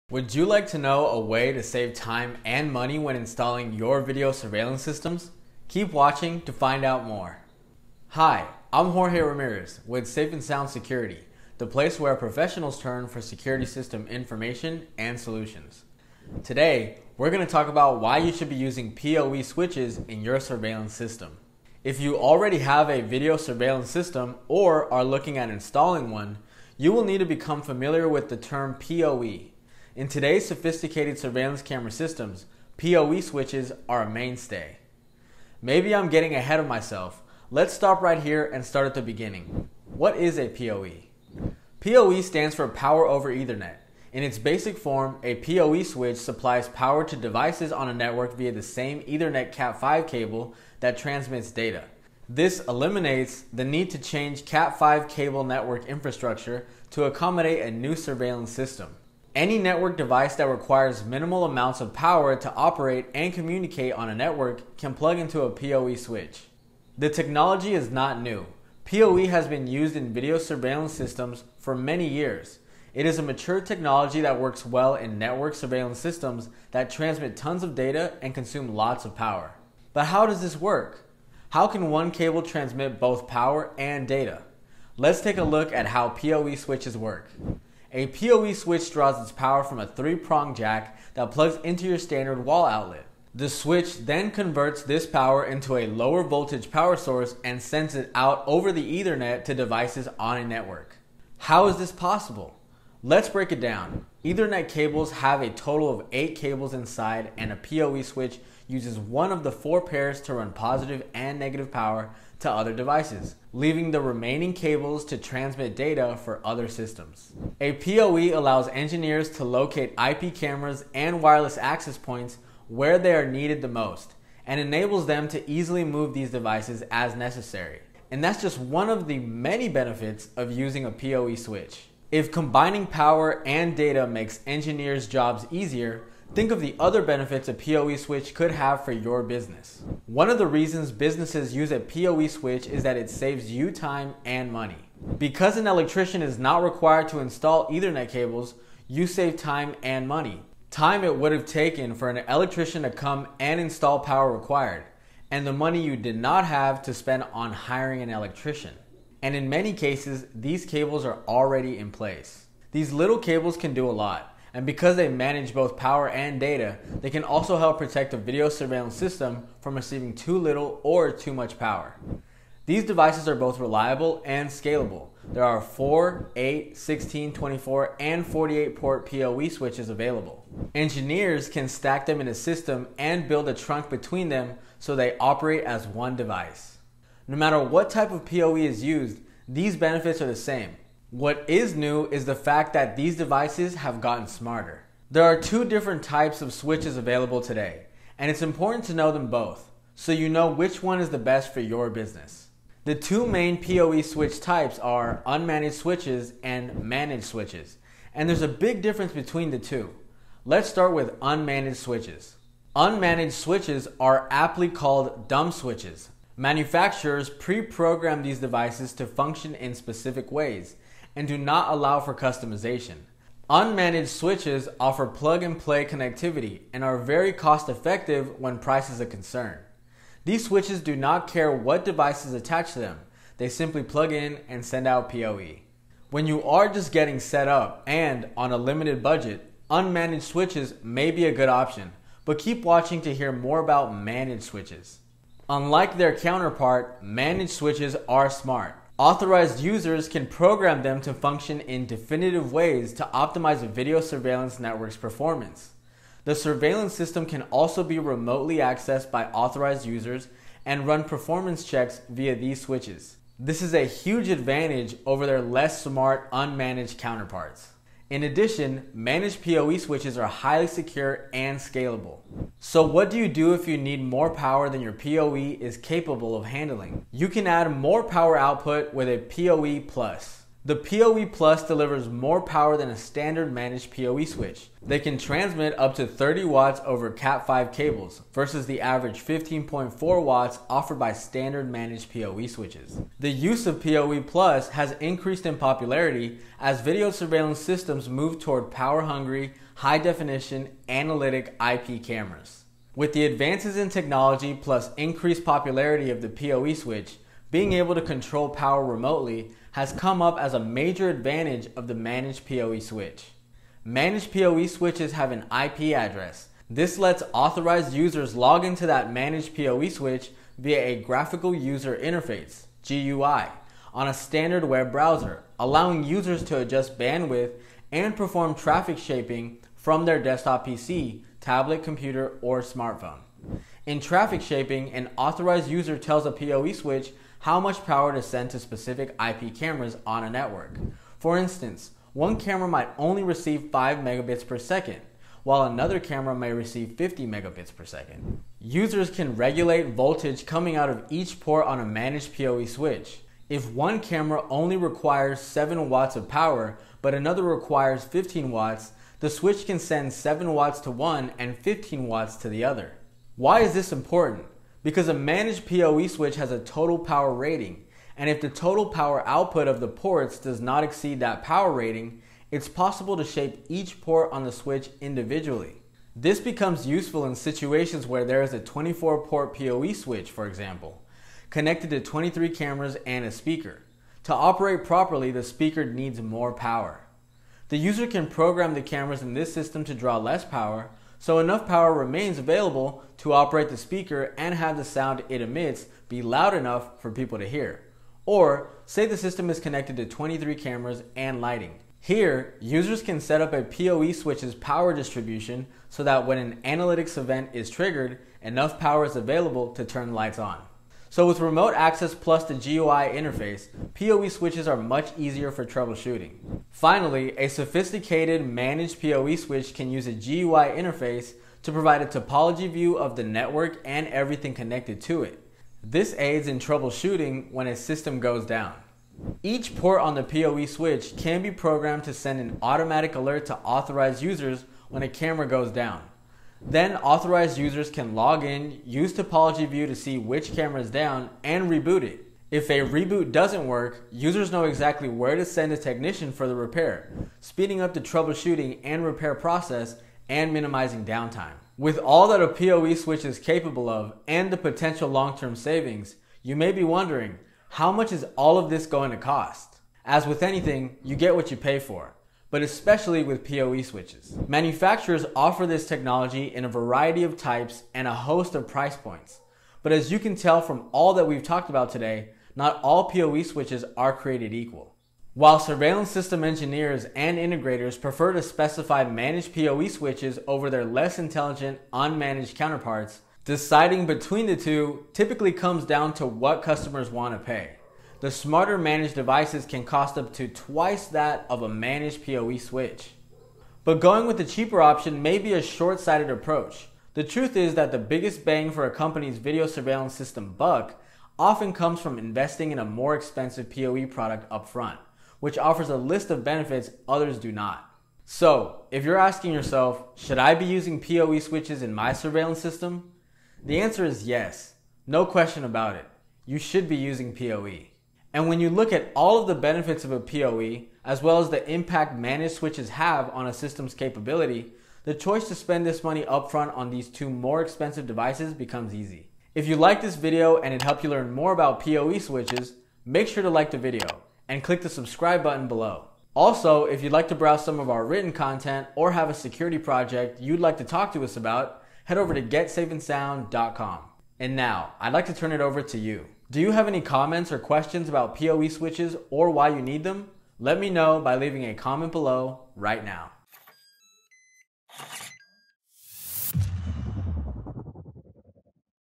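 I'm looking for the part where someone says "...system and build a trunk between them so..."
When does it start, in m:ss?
3:02.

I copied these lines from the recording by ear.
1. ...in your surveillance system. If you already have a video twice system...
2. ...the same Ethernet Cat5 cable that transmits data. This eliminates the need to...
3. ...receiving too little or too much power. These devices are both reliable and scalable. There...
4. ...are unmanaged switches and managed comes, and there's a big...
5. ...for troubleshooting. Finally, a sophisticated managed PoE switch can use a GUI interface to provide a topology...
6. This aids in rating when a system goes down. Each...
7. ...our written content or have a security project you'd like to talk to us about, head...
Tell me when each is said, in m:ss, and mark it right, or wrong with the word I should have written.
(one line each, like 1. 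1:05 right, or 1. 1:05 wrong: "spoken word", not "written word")
1. 0:20 wrong: "surveillance", not "twice"
2. 0:48 right
3. 2:49 right
4. 3:24 wrong: "switches", not "comes"
5. 6:55 right
6. 7:05 wrong: "troubleshooting", not "rating"
7. 8:57 right.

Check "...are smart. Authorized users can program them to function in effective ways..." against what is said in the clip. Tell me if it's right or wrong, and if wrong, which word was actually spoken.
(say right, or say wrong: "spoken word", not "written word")
wrong: "definitive", not "effective".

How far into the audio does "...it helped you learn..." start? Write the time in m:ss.
8:50.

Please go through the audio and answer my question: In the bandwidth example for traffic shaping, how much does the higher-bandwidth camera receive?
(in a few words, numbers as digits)
50 megabits per second.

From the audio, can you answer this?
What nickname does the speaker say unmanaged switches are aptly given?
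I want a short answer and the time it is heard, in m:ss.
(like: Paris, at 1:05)
dumb switches, at 3:35.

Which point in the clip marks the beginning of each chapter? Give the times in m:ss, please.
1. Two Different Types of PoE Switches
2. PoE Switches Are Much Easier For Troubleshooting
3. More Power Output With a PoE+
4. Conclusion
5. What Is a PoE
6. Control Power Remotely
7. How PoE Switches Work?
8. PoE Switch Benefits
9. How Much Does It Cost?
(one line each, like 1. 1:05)
1. 3:15
2. 6:51
3. 4:32
4. 8:28
5. 0:35
6. 5:03
7. 1:19
8. 2:12
9. 7:32.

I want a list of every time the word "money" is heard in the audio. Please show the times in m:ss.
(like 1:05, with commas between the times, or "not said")
0:02, 2:24, 2:30, 2:35, 8:46.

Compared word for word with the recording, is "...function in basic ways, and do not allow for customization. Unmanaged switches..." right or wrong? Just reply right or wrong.
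wrong.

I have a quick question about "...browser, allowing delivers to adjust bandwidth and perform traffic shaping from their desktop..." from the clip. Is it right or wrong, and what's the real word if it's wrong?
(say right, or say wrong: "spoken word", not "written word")
wrong: "users", not "delivers".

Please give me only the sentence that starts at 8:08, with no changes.
The smarter managed devices can cost up to twice that of a managed PoE switch.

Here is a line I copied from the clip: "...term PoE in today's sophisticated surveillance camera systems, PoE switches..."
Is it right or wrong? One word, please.
right.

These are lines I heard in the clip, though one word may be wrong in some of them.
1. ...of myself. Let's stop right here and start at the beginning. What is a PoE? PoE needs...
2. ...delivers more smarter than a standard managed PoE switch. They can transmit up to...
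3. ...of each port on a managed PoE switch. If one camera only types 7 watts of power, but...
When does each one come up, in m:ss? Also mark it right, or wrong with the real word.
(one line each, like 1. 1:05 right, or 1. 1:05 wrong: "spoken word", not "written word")
1. 0:36 wrong: "stands", not "needs"
2. 4:41 wrong: "power", not "smarter"
3. 5:50 wrong: "requires", not "types".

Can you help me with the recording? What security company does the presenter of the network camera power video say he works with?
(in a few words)
Safe and Sound Security.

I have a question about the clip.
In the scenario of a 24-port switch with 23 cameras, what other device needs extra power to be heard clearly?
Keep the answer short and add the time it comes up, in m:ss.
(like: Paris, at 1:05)
a speaker, at 6:23.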